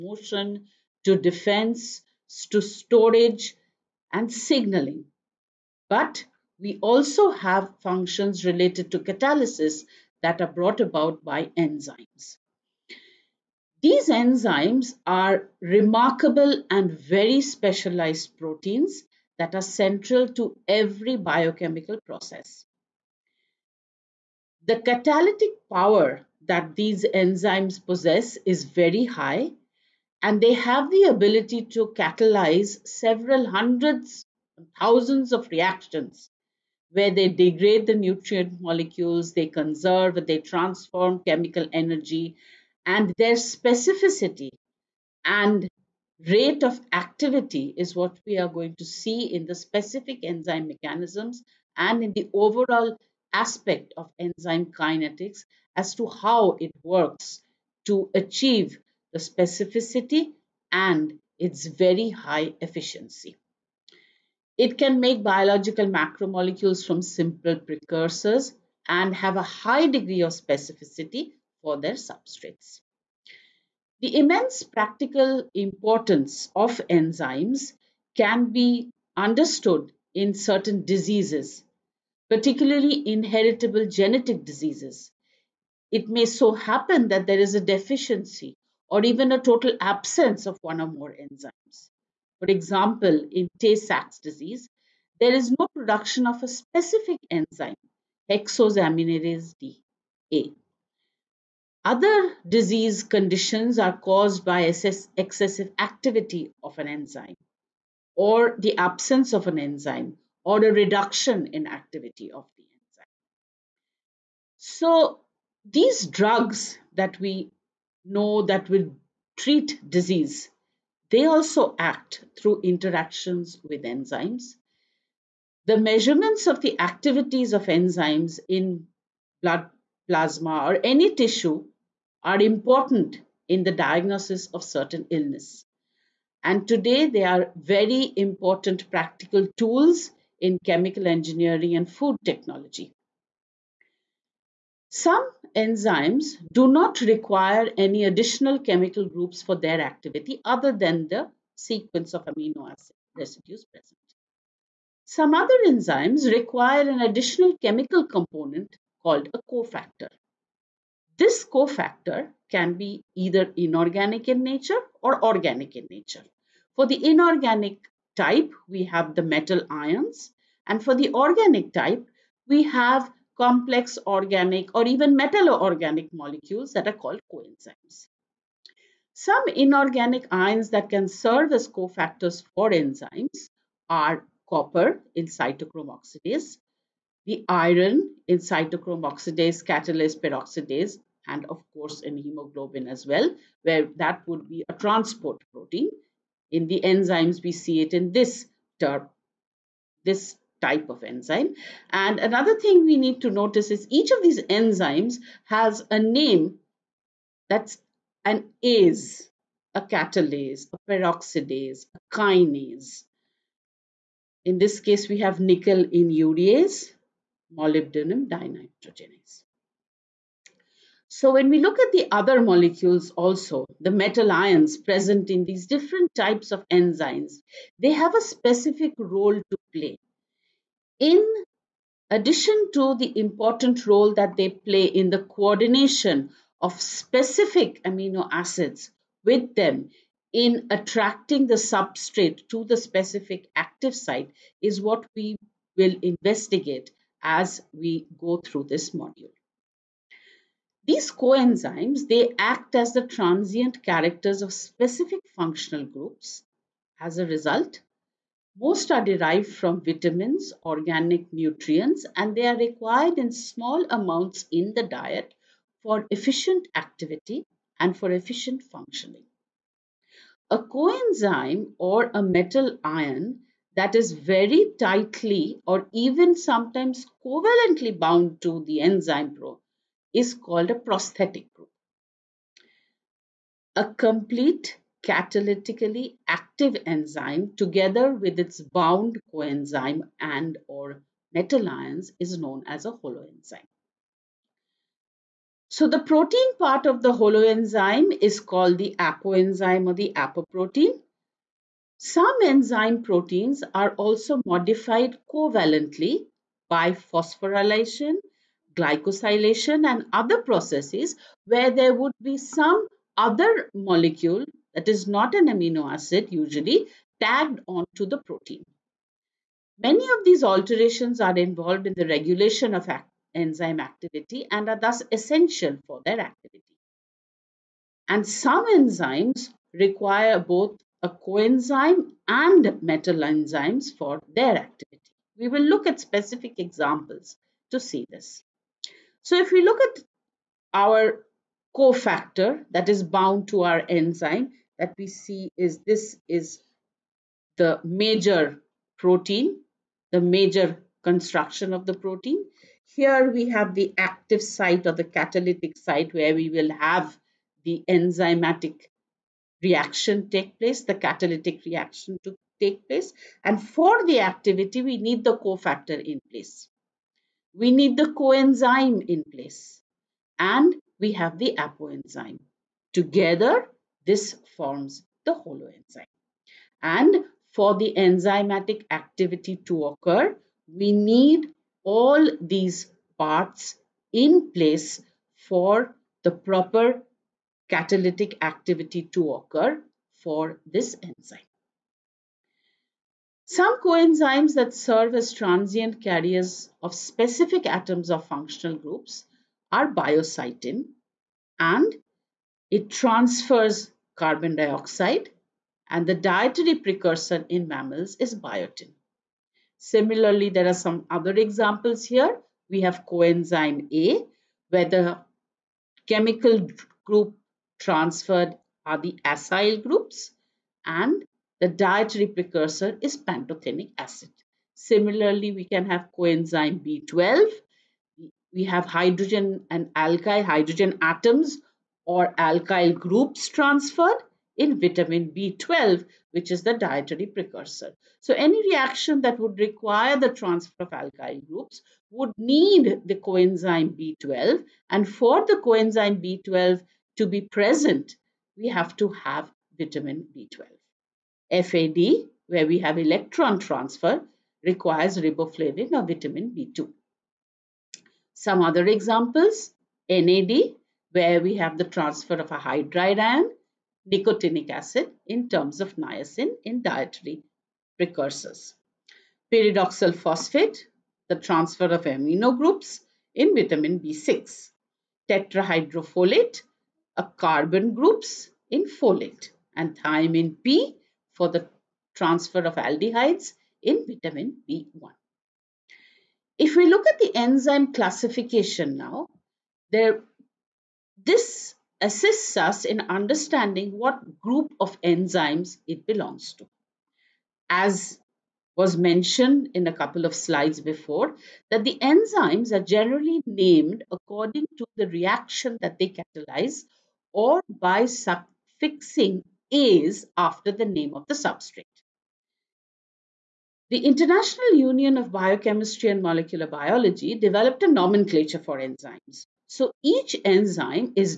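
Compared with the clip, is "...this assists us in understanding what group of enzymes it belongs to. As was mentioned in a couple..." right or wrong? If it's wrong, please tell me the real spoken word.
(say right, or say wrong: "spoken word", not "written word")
right.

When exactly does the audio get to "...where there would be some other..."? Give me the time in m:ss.
5:11.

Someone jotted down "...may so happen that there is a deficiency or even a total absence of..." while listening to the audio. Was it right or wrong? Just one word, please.
right.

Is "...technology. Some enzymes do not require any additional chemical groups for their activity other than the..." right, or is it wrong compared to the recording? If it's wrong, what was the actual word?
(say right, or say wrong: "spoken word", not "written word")
right.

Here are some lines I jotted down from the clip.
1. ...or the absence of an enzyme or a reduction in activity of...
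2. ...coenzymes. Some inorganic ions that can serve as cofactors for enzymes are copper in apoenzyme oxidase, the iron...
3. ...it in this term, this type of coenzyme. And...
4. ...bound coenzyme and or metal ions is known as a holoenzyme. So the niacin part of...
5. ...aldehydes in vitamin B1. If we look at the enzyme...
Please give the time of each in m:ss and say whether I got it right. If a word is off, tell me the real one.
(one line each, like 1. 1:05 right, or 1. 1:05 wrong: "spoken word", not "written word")
1. 1:48 right
2. 2:57 wrong: "cytochrome", not "apoenzyme"
3. 3:17 wrong: "enzyme", not "coenzyme"
4. 4:48 wrong: "protein", not "niacin"
5. 8:02 right.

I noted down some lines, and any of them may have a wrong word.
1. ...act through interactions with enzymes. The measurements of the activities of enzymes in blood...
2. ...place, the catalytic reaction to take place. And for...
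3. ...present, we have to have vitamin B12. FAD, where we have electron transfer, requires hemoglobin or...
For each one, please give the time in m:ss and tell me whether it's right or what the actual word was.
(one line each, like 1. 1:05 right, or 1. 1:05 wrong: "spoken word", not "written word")
1. 2:01 right
2. 6:00 right
3. 7:27 wrong: "riboflavin", not "hemoglobin".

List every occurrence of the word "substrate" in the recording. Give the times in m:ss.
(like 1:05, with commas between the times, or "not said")
1:11, 4:01, 8:31.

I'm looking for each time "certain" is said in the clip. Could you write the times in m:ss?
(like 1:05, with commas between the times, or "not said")
1:20, 2:14.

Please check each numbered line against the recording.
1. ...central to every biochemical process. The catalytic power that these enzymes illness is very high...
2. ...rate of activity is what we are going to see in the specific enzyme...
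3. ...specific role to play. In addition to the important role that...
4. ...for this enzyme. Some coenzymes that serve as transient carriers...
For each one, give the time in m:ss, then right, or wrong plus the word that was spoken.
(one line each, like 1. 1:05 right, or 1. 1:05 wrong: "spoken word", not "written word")
1. 0:19 wrong: "possess", not "illness"
2. 0:46 right
3. 3:48 right
4. 6:30 right.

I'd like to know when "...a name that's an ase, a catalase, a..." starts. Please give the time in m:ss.
3:25.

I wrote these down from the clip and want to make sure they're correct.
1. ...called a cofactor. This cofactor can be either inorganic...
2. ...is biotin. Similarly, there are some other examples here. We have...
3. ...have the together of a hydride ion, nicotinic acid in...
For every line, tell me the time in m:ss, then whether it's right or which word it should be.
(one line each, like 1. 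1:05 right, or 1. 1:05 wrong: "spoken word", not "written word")
1. 2:39 right
2. 6:48 right
3. 7:41 wrong: "transfer", not "together".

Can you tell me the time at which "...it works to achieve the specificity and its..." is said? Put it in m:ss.
0:56.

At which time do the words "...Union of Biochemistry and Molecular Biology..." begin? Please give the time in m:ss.
8:34.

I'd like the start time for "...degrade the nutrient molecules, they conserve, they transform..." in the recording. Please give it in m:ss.
0:37.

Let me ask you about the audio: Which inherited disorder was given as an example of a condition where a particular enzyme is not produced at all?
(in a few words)
Tay Sachs disease.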